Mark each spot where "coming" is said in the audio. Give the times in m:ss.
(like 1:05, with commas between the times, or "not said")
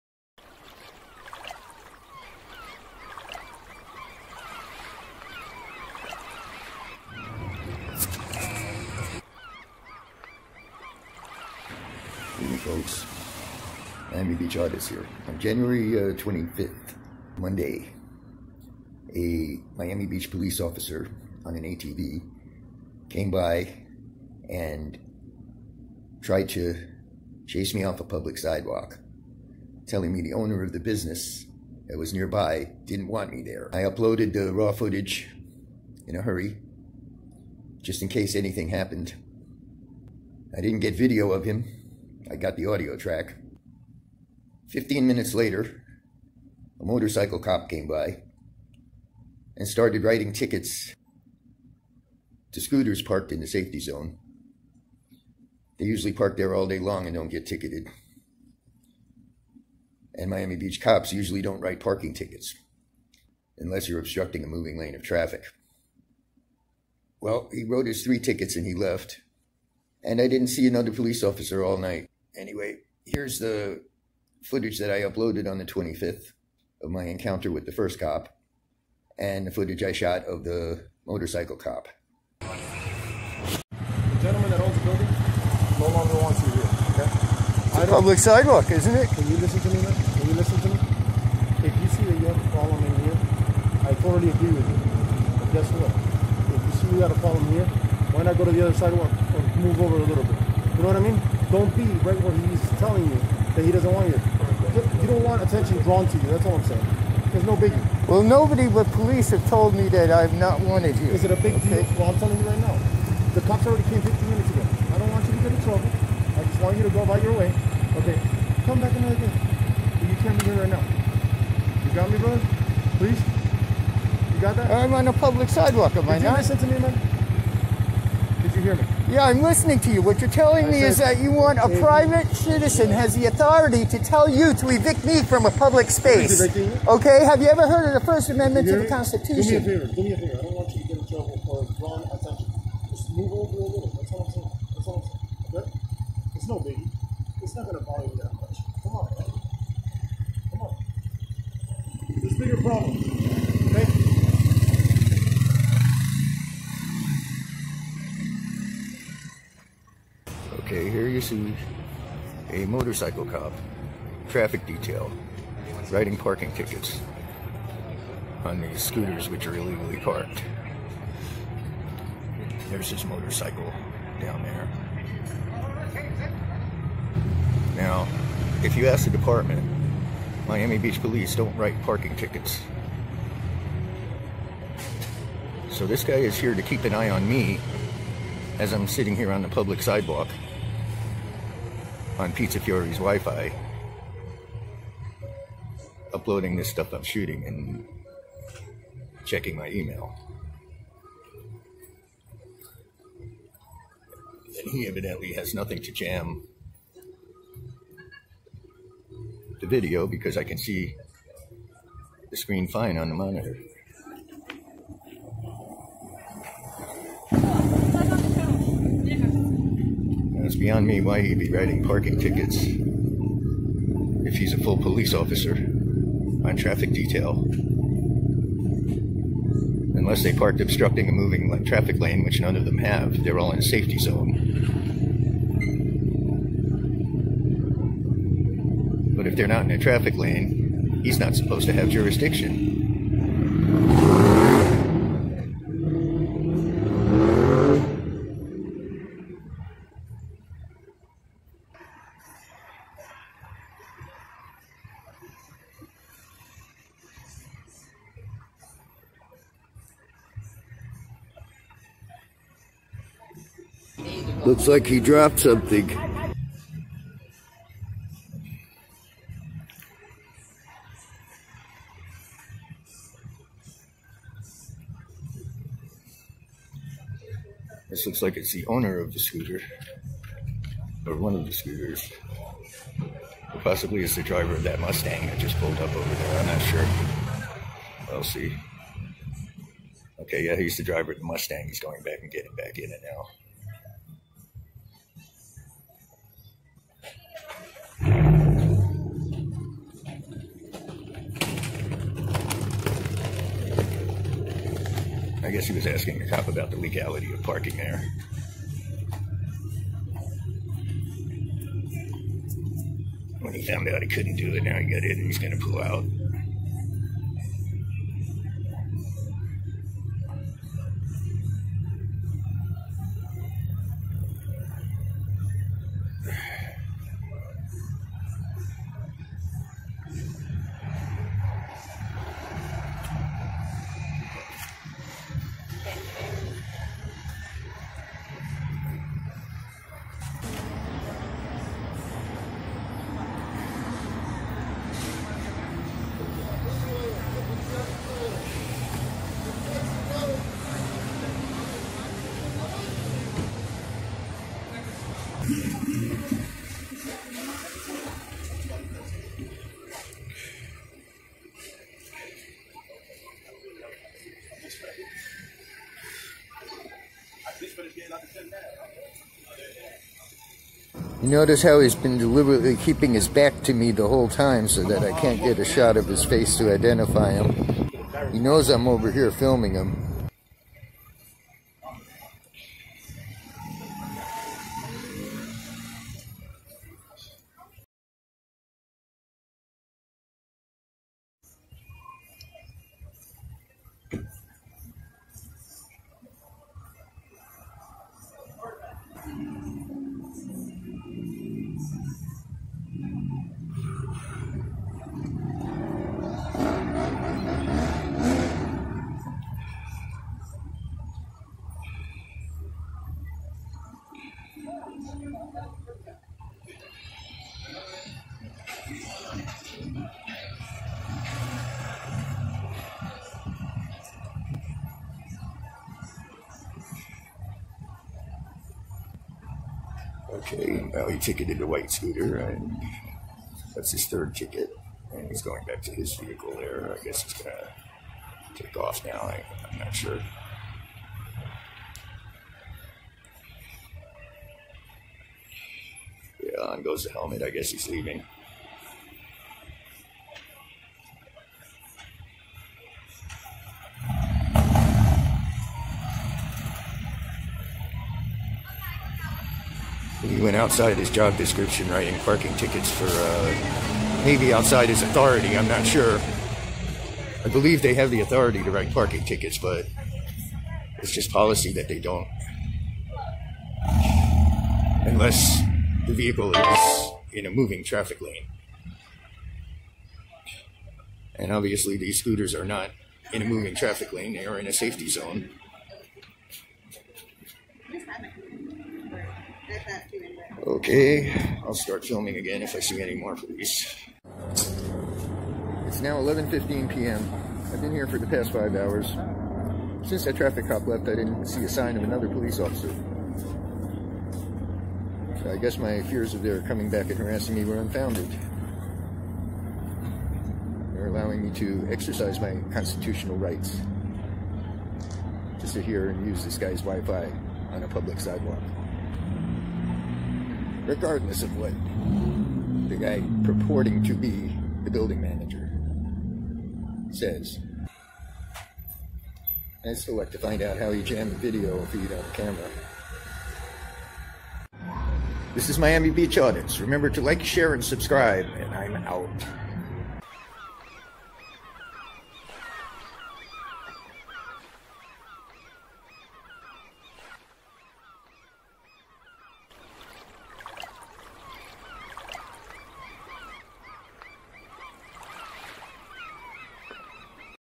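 8:26.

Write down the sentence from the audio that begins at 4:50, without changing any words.
Okay, yeah, he's the driver of the Mustang.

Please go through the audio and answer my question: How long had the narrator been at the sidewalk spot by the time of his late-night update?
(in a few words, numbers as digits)
5 hours.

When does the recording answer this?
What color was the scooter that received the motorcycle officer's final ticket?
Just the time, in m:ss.
7:11.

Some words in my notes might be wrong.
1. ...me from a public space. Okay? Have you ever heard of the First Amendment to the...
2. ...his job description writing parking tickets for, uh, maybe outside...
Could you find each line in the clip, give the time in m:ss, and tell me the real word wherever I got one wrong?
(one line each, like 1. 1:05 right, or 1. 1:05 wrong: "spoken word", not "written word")
1. 2:15 right
2. 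7:40 right.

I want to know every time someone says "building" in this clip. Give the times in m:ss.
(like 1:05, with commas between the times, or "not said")
1:24, 8:44.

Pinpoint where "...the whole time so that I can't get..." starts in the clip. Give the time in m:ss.
6:13.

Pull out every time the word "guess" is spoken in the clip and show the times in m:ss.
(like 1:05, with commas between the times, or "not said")
1:35, 5:05, 7:17, 7:27, 8:25.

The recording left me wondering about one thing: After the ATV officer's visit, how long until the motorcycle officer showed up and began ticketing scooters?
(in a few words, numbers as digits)
Fifteen minutes.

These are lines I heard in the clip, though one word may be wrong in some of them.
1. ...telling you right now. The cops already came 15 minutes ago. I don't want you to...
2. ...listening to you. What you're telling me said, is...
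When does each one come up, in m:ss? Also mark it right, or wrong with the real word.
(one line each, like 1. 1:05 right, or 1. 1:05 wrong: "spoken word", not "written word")
1. 1:52 right
2. 2:09 right.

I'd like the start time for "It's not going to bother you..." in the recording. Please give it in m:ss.
2:27.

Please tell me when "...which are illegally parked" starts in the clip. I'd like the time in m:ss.
2:49.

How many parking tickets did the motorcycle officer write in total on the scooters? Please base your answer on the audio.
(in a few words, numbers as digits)
3.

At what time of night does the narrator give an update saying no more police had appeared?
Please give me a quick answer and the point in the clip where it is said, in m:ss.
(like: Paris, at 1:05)
11:15 p.m., at 8:16.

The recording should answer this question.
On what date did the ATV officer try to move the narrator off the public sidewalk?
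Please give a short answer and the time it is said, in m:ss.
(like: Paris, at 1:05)
January 25, at 0:15.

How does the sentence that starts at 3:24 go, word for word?
And he evidently has nothing to jam the video because I can see the screen fine on the monitor.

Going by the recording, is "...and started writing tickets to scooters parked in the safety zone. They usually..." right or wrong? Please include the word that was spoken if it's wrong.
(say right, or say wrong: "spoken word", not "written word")
right.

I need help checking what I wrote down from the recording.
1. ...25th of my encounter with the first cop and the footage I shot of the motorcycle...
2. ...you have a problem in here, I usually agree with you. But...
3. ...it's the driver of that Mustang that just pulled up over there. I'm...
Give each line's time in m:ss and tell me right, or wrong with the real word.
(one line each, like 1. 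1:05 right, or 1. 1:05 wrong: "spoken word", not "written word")
1. 1:15 right
2. 1:32 wrong: "totally", not "usually"
3. 4:44 right.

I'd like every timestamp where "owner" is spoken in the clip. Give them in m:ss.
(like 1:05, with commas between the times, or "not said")
0:30, 4:38.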